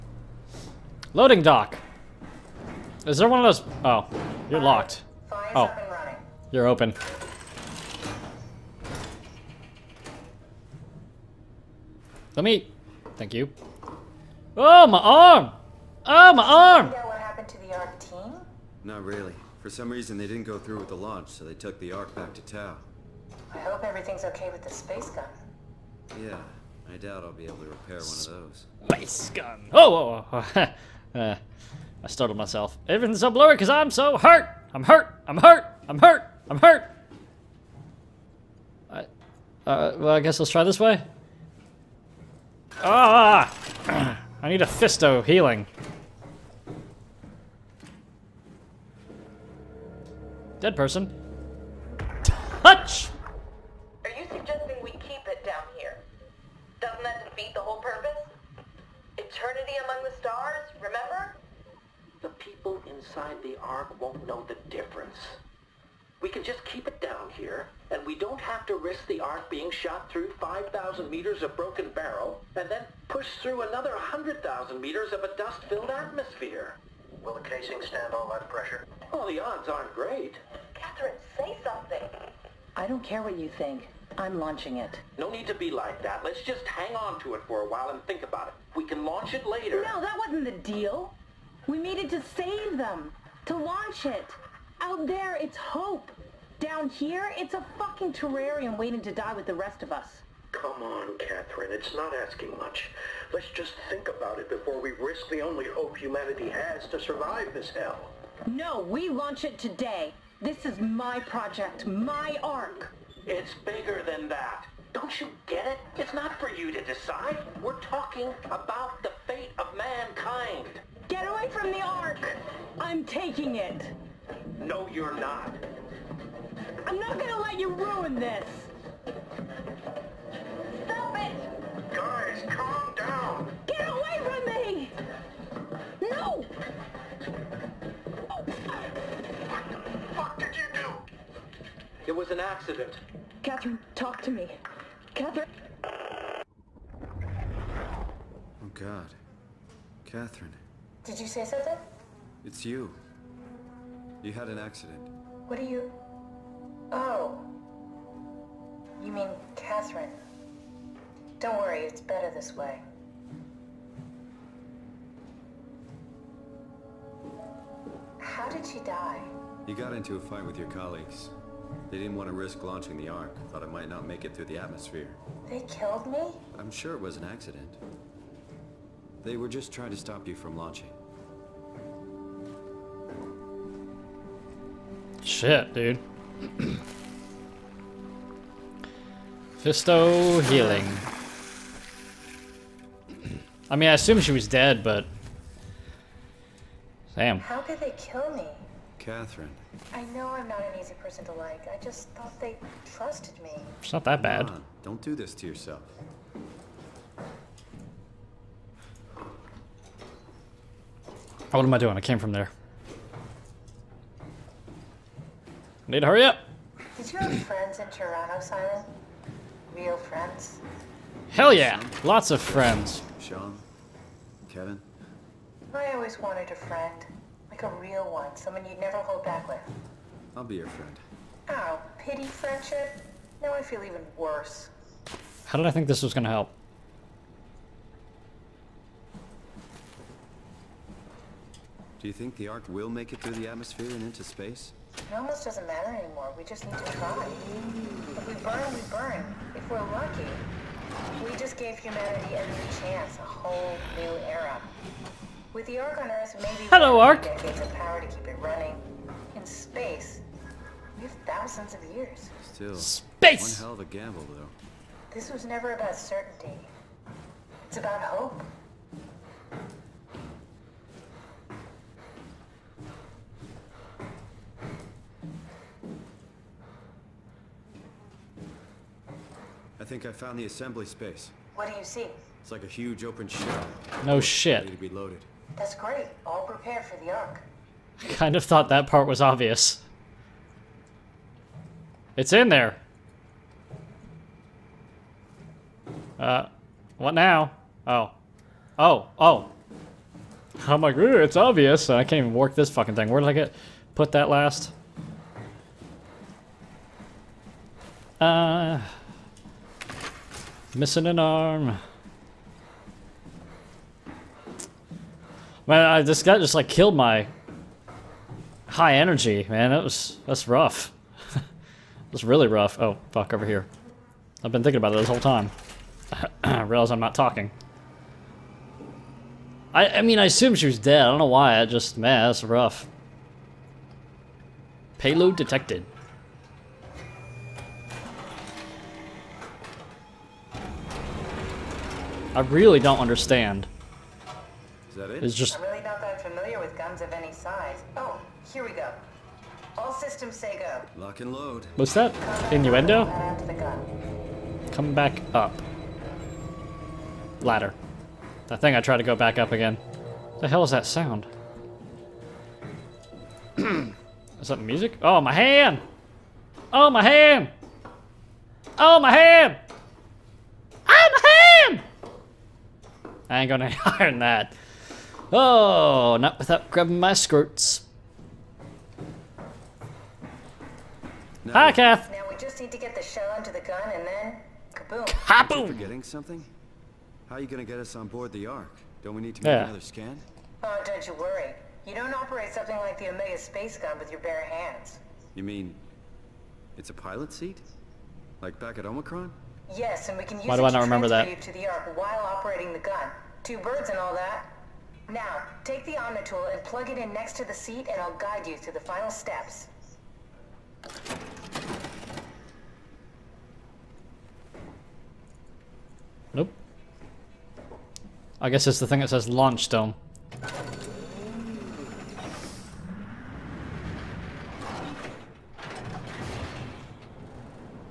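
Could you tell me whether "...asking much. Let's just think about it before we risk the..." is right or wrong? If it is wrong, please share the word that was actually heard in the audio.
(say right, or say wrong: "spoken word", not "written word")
right.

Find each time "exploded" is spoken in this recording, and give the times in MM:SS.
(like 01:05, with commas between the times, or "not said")
not said.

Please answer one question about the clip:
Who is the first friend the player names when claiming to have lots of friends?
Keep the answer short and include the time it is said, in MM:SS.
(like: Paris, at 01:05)
Sean, at 03:43.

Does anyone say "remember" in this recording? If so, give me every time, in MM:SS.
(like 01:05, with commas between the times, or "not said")
01:00, 06:40.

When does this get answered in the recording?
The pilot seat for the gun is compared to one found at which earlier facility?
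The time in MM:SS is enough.
06:38.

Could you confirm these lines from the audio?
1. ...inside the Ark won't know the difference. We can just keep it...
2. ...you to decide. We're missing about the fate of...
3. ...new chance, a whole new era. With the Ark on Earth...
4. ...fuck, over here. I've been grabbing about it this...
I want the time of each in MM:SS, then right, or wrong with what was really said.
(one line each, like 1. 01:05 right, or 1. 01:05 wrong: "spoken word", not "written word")
1. 01:02 right
2. 01:56 wrong: "talking", not "missing"
3. 04:12 right
4. 05:23 wrong: "thinking", not "grabbing".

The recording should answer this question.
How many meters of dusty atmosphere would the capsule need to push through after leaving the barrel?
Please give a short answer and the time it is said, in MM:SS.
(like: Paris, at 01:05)
100,000 meters, at 01:13.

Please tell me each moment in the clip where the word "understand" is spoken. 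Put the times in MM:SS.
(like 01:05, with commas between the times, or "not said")
05:42.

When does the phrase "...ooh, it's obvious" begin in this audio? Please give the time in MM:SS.
05:00.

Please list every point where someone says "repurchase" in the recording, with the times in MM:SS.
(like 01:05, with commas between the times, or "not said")
not said.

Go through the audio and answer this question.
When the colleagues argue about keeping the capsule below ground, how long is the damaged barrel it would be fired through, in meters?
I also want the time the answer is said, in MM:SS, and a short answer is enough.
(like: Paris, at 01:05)
5,000 meters, at 01:10.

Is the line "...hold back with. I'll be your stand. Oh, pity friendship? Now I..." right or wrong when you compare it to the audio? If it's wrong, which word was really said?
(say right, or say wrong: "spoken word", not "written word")
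wrong: "friend", not "stand".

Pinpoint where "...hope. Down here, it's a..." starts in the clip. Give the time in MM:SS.
01:35.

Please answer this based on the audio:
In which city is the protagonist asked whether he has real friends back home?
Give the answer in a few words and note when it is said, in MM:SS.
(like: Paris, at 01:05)
Toronto, at 03:37.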